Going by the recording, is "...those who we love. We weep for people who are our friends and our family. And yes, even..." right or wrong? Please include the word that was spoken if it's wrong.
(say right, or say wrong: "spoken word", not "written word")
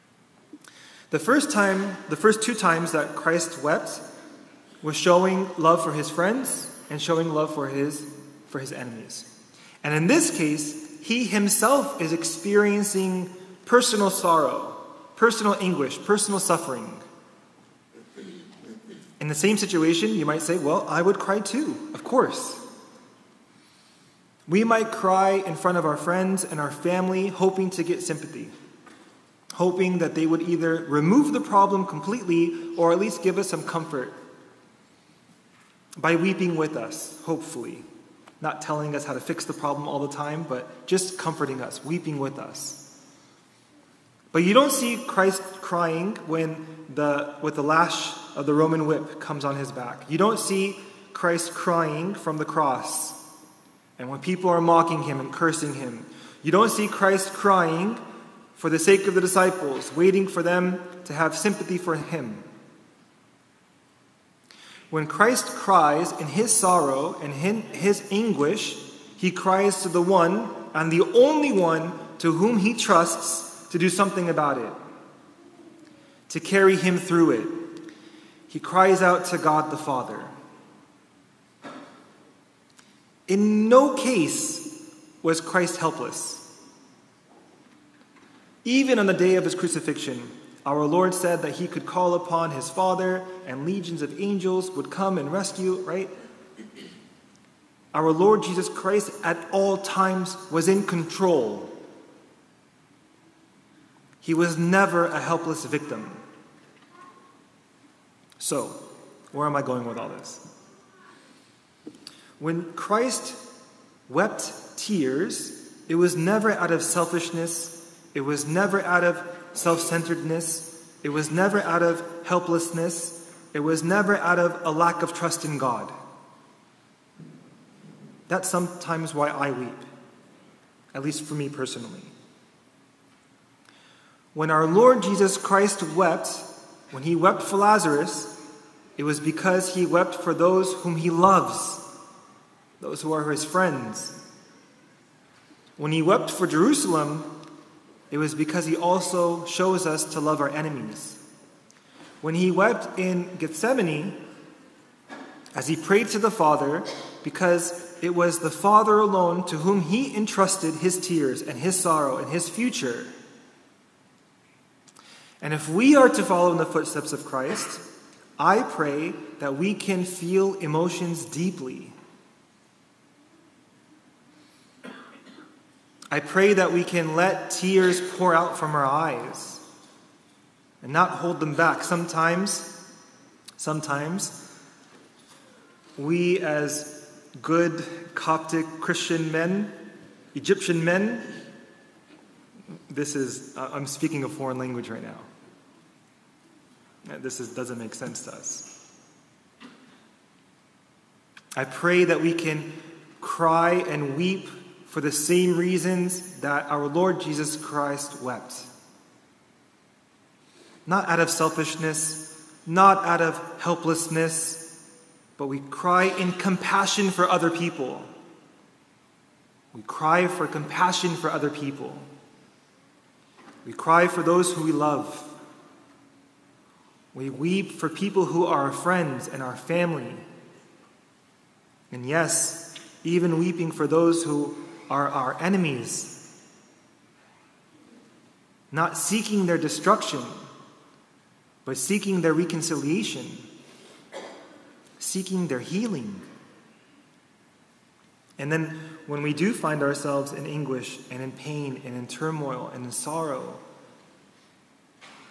right.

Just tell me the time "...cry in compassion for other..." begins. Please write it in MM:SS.
03:35.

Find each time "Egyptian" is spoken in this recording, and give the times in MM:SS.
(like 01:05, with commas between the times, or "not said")
03:10.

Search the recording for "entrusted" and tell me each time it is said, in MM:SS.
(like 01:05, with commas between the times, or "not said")
02:40.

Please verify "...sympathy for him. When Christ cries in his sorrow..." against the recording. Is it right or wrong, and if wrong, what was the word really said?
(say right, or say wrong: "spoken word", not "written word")
right.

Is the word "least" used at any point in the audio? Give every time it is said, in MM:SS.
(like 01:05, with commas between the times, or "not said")
00:32, 02:11.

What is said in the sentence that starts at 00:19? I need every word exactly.
In the same situation, you might say, Well, I would cry too, of course.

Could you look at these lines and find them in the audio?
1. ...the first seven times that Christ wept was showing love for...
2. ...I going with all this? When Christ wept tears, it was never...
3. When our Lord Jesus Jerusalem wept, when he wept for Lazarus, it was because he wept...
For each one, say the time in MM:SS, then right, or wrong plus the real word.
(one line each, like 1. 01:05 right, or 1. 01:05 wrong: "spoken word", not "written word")
1. 00:02 wrong: "two", not "seven"
2. 01:49 right
3. 02:14 wrong: "Christ", not "Jerusalem".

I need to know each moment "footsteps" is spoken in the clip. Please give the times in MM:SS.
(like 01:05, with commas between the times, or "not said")
02:46.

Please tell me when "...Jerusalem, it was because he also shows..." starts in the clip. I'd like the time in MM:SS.
02:26.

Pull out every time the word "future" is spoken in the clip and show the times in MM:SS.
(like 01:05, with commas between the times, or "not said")
02:42.